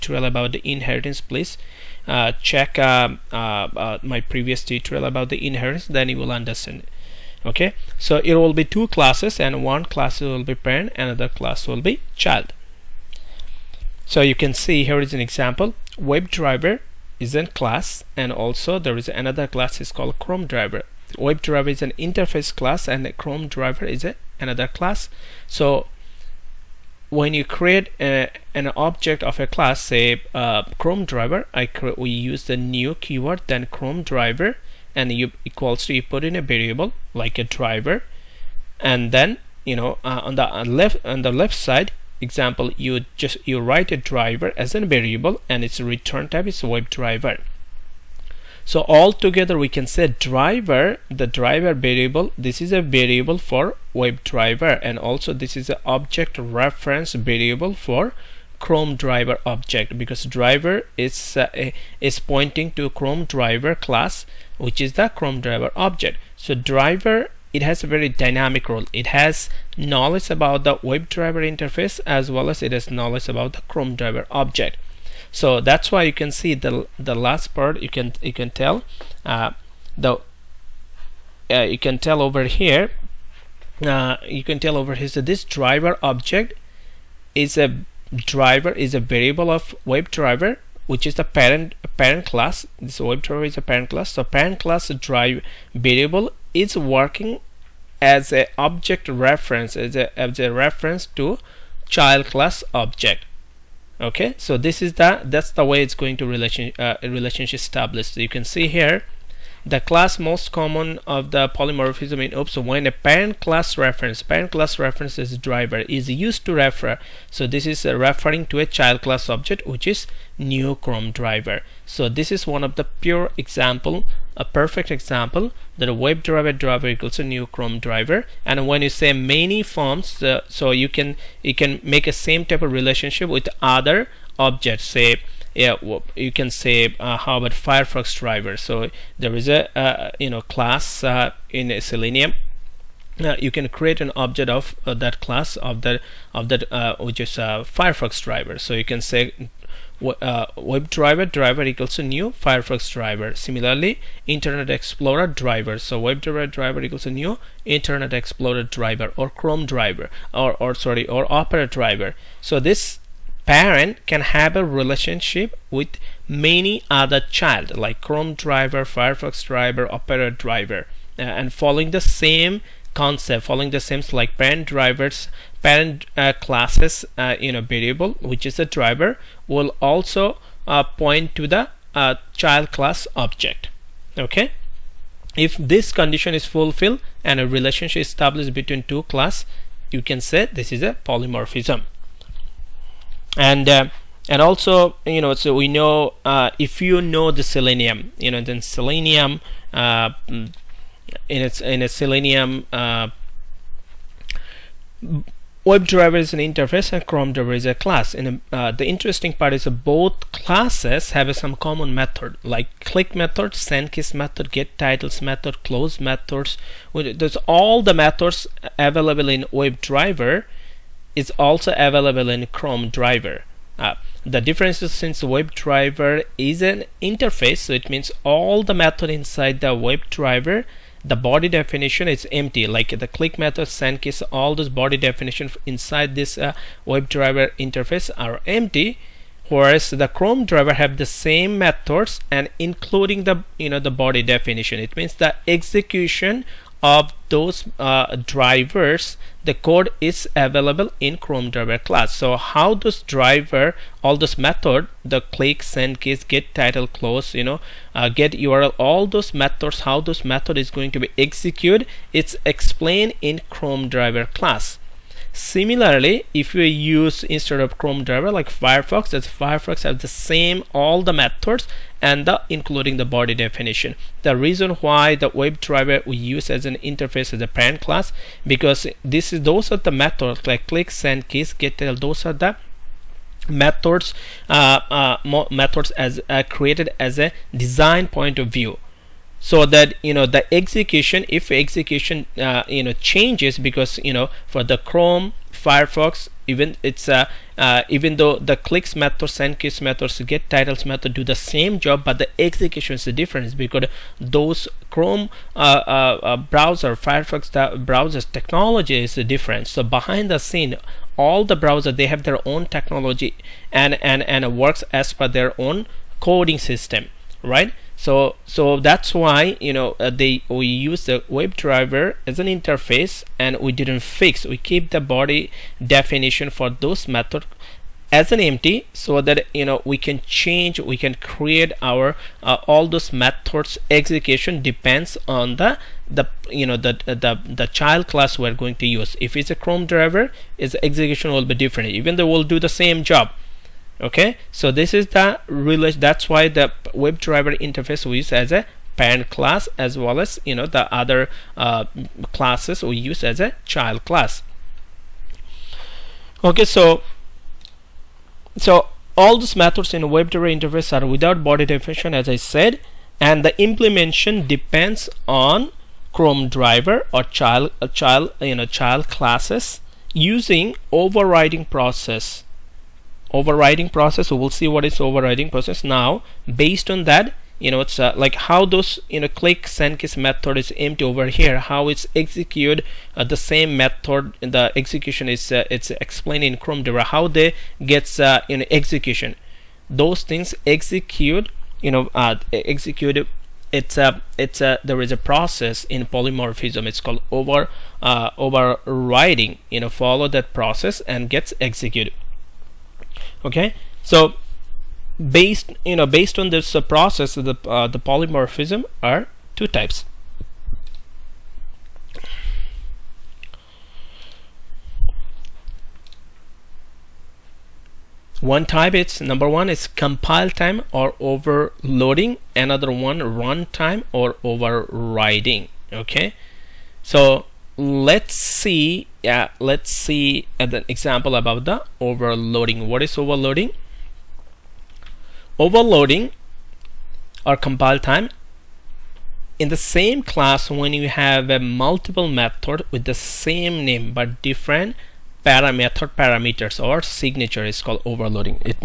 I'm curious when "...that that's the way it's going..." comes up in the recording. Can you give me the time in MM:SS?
01:44.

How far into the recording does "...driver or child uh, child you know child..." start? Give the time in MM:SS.
06:06.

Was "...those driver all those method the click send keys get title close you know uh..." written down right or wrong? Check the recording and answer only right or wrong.
right.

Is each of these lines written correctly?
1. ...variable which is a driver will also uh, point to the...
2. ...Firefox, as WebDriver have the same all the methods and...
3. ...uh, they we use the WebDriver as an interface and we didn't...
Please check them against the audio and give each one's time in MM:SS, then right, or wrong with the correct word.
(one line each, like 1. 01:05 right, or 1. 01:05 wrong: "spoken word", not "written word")
1. 02:57 right
2. 04:28 wrong: "Firefox", not "WebDriver"
3. 05:19 right.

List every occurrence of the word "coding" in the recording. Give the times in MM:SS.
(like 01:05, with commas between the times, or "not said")
05:16.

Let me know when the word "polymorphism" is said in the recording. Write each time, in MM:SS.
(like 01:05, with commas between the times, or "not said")
01:51, 03:11, 06:36, 06:47.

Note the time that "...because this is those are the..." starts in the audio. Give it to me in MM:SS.
04:38.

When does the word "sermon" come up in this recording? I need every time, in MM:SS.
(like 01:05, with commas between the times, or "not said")
not said.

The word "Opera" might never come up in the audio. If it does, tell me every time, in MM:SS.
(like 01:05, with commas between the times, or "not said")
02:41, 02:49.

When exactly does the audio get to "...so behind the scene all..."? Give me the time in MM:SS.
05:09.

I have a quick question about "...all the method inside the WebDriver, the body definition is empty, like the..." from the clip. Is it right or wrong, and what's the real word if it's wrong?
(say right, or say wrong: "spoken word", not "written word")
right.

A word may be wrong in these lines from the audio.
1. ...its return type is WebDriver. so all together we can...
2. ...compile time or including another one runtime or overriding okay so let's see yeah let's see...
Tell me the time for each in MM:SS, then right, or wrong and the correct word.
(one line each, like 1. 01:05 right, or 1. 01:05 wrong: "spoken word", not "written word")
1. 00:45 right
2. 06:59 wrong: "overloading", not "including".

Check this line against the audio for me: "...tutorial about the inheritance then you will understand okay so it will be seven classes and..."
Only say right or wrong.
wrong.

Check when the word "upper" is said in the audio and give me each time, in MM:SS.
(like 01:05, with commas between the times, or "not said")
not said.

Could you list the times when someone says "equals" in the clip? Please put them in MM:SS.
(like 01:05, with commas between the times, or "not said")
00:35, 02:06, 02:31, 02:36.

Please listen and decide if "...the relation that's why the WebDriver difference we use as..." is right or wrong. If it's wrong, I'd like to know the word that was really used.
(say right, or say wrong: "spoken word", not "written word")
wrong: "interface", not "difference".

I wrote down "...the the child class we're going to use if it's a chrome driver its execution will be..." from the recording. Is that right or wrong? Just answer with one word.
right.